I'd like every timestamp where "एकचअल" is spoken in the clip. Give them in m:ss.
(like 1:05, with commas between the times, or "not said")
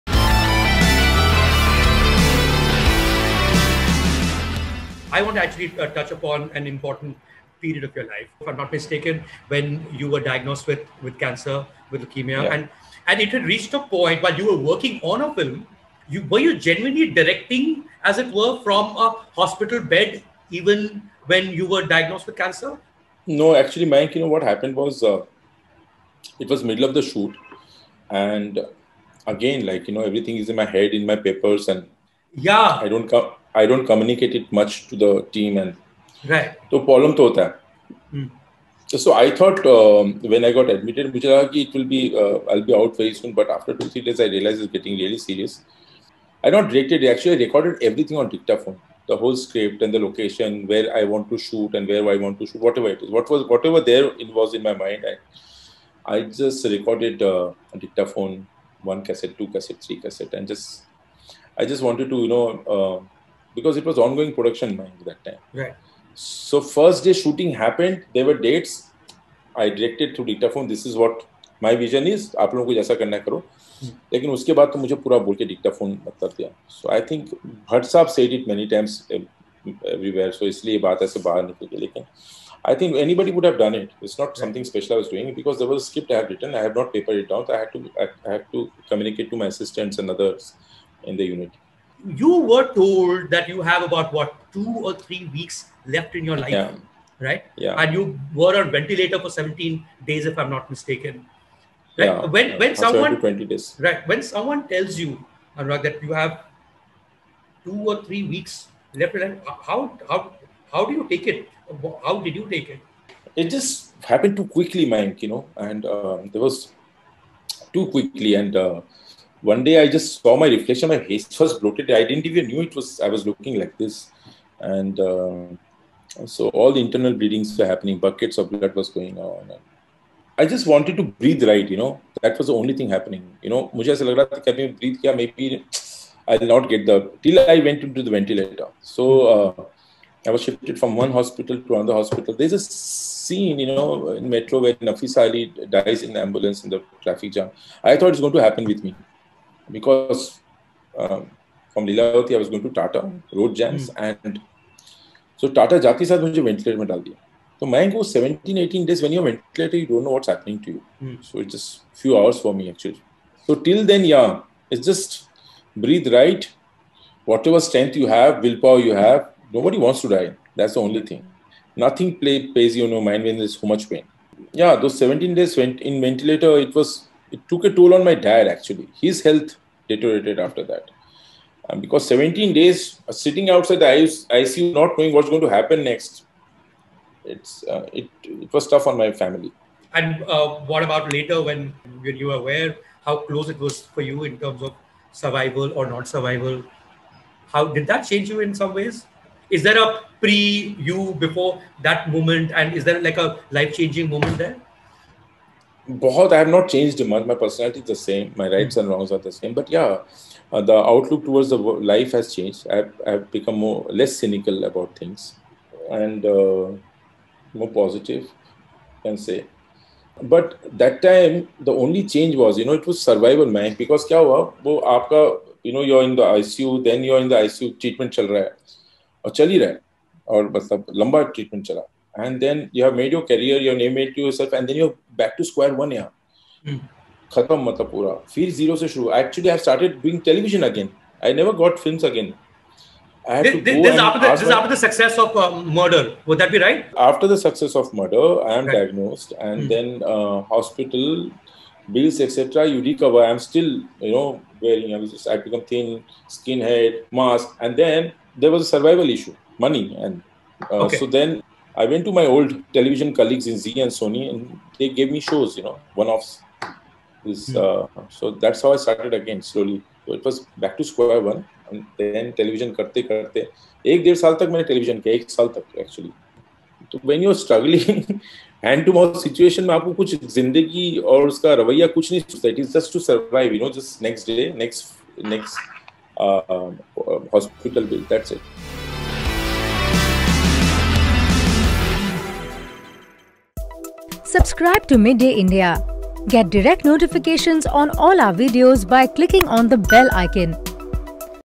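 0:47, 3:59, 4:35.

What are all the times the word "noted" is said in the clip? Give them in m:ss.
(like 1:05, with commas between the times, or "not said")
not said.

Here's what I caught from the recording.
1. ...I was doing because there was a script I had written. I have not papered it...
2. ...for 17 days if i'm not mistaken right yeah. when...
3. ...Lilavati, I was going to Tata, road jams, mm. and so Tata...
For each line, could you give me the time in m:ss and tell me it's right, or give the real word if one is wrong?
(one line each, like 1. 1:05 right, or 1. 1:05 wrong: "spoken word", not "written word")
1. 1:24 right
2. 1:39 right
3. 2:31 right.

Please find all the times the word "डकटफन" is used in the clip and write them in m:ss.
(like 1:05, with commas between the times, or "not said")
0:48, 1:15.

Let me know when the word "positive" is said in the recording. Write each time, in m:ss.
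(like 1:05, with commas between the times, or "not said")
3:37.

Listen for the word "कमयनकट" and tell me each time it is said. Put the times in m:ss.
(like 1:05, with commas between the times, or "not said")
0:33.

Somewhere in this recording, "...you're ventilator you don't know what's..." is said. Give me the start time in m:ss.
2:39.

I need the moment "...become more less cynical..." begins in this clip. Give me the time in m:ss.
3:33.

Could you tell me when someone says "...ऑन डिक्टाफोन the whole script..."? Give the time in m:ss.
0:48.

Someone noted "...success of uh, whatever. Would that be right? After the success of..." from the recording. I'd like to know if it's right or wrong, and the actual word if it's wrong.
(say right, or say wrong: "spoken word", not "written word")
wrong: "murder", not "whatever".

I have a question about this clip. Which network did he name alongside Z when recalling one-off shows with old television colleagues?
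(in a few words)
Sony.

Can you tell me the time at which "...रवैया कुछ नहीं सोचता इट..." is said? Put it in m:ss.
4:41.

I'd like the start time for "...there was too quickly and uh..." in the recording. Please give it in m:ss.
1:56.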